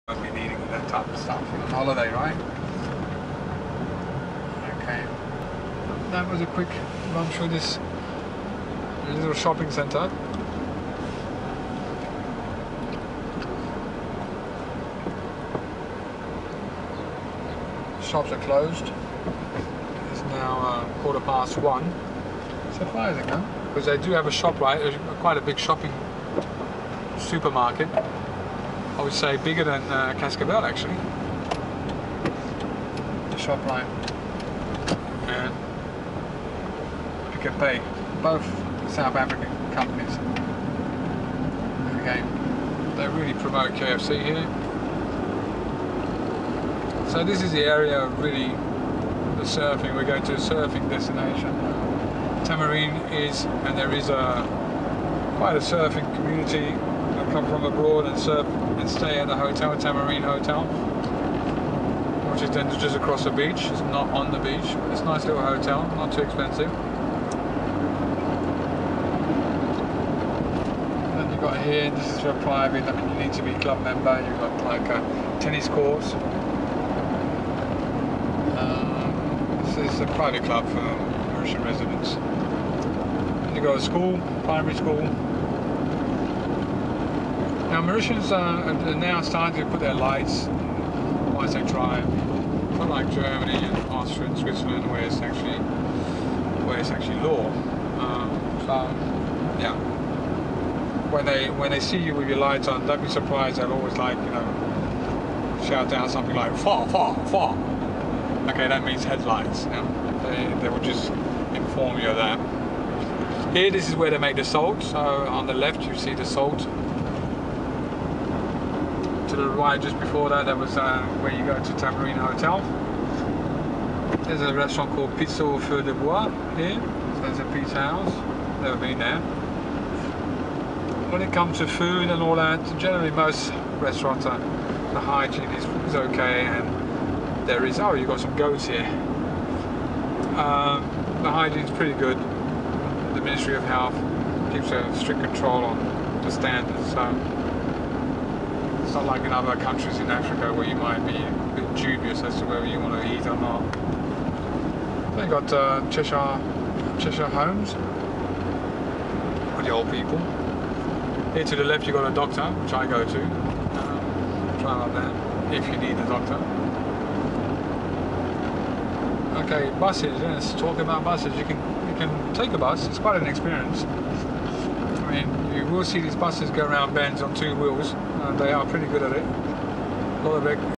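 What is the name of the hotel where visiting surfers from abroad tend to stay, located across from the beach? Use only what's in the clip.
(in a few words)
Tamarine Hotel.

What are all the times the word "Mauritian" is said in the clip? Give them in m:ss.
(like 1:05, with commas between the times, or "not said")
1:21, 1:27.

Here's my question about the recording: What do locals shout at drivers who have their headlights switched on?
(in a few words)
far far far.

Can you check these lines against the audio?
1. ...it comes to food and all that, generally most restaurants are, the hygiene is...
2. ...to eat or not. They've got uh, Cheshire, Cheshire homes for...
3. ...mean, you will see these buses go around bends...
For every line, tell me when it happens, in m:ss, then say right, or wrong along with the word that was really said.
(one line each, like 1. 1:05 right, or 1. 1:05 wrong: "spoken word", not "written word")
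1. 2:11 right
2. 2:33 right
3. 2:55 right.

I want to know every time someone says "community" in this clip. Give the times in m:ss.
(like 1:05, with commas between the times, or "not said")
0:56.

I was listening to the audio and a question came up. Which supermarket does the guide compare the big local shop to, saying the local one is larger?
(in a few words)
Cascavelle.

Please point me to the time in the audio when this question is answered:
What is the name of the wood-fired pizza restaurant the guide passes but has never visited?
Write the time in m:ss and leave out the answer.
2:05.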